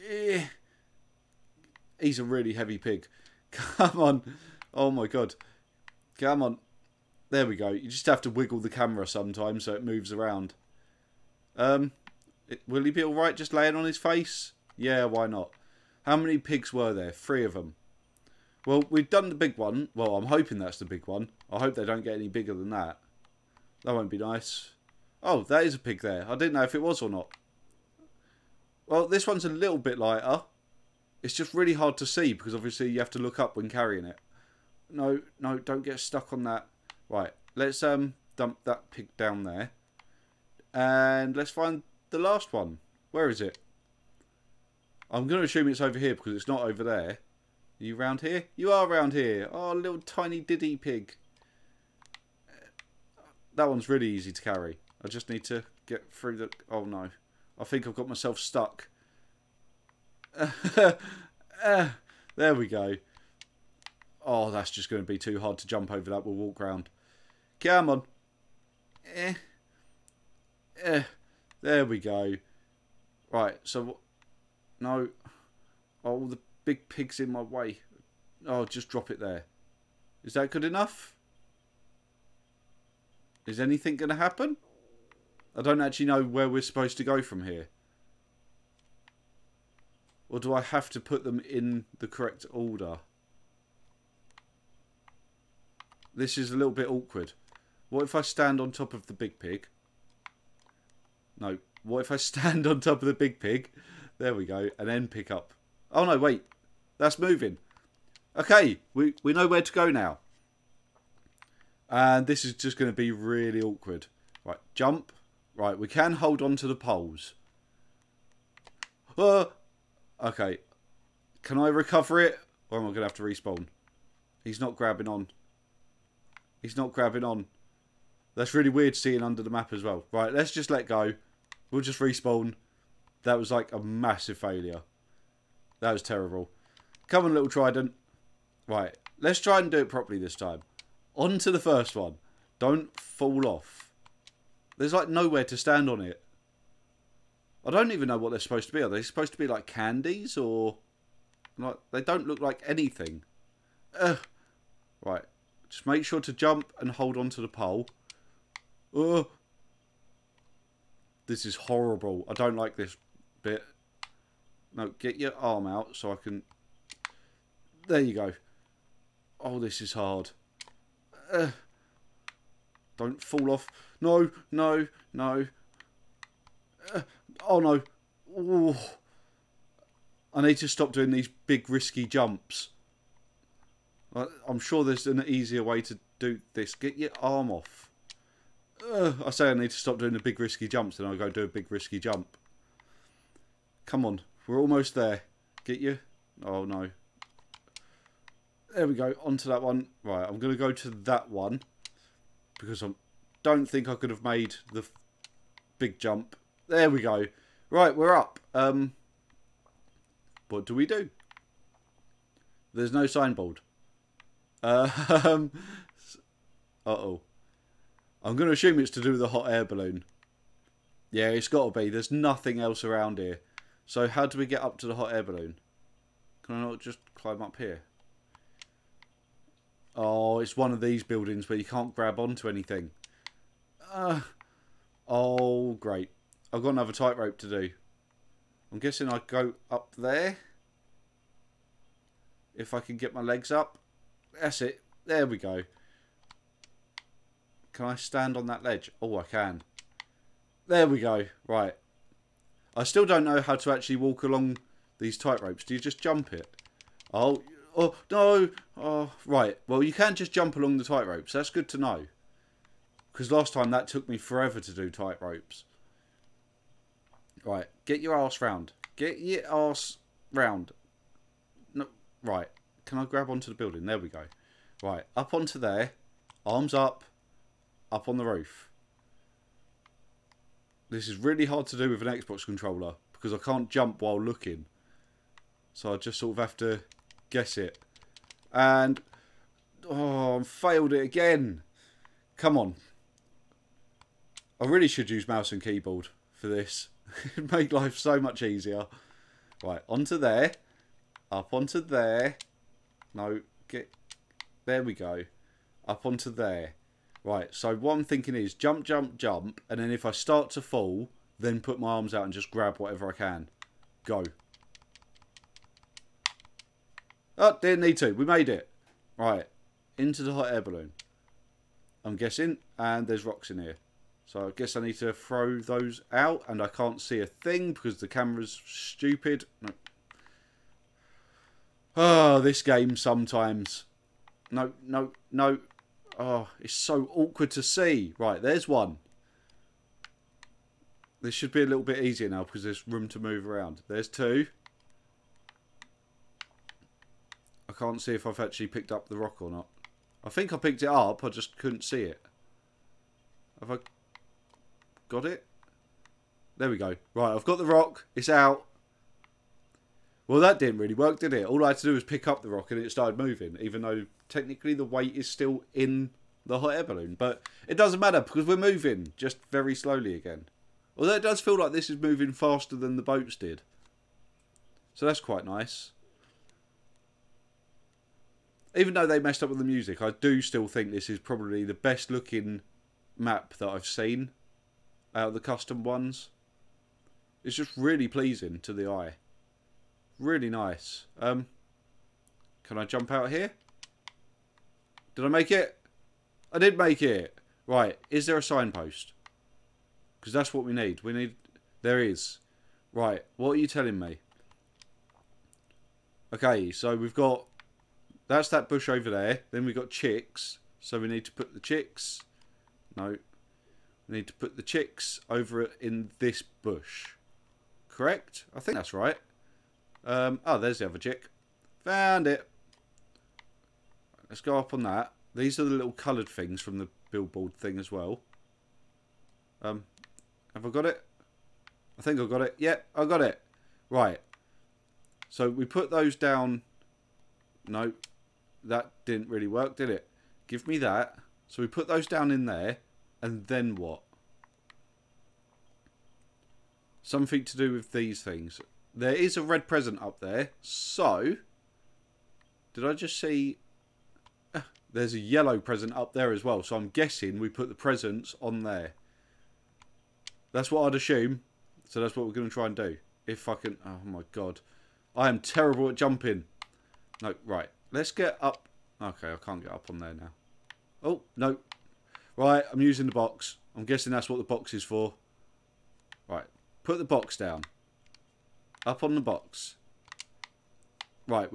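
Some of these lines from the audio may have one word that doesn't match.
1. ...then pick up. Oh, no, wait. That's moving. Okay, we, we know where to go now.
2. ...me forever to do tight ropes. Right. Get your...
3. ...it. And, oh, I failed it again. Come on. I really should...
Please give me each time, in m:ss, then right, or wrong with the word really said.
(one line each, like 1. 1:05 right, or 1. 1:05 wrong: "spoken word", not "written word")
1. 1:44 right
2. 4:24 right
3. 4:47 right.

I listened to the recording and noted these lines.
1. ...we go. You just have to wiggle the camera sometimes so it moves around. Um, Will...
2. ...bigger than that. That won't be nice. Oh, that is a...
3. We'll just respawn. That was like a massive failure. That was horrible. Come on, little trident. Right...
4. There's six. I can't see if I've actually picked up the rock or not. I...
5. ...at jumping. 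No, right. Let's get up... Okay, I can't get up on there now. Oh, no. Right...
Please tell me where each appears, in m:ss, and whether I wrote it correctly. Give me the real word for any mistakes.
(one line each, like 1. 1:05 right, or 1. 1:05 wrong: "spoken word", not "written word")
1. 0:07 right
2. 0:22 right
3. 2:11 wrong: "terrible", not "horrible"
4. 5:43 wrong: "two", not "six"
5. 7:45 right.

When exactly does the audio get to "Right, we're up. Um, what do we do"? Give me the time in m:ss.
3:27.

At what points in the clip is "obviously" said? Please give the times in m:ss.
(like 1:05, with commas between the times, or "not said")
0:32.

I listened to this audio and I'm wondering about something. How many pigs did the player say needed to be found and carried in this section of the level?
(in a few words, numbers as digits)
3.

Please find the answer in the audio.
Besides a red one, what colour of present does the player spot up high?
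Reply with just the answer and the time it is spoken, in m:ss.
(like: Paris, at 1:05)
yellow, at 7:35.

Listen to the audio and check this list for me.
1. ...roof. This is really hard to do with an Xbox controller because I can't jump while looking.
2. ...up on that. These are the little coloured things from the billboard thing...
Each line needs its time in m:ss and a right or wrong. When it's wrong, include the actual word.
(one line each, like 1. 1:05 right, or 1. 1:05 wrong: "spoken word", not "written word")
1. 4:38 right
2. 7:04 right.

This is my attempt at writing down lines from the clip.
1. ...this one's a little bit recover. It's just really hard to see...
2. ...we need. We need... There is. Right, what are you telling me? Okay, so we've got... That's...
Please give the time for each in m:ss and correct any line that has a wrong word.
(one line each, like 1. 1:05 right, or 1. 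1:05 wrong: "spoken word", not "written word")
1. 0:29 wrong: "lighter", not "recover"
2. 6:40 right.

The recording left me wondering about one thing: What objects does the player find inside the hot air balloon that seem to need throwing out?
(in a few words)
rocks.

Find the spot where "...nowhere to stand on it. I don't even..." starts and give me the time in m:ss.
2:25.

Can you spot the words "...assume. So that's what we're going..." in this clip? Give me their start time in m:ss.
7:40.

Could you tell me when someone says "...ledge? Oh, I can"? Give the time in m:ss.
4:08.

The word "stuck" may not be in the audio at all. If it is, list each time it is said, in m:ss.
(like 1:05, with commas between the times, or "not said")
0:36, 0:58.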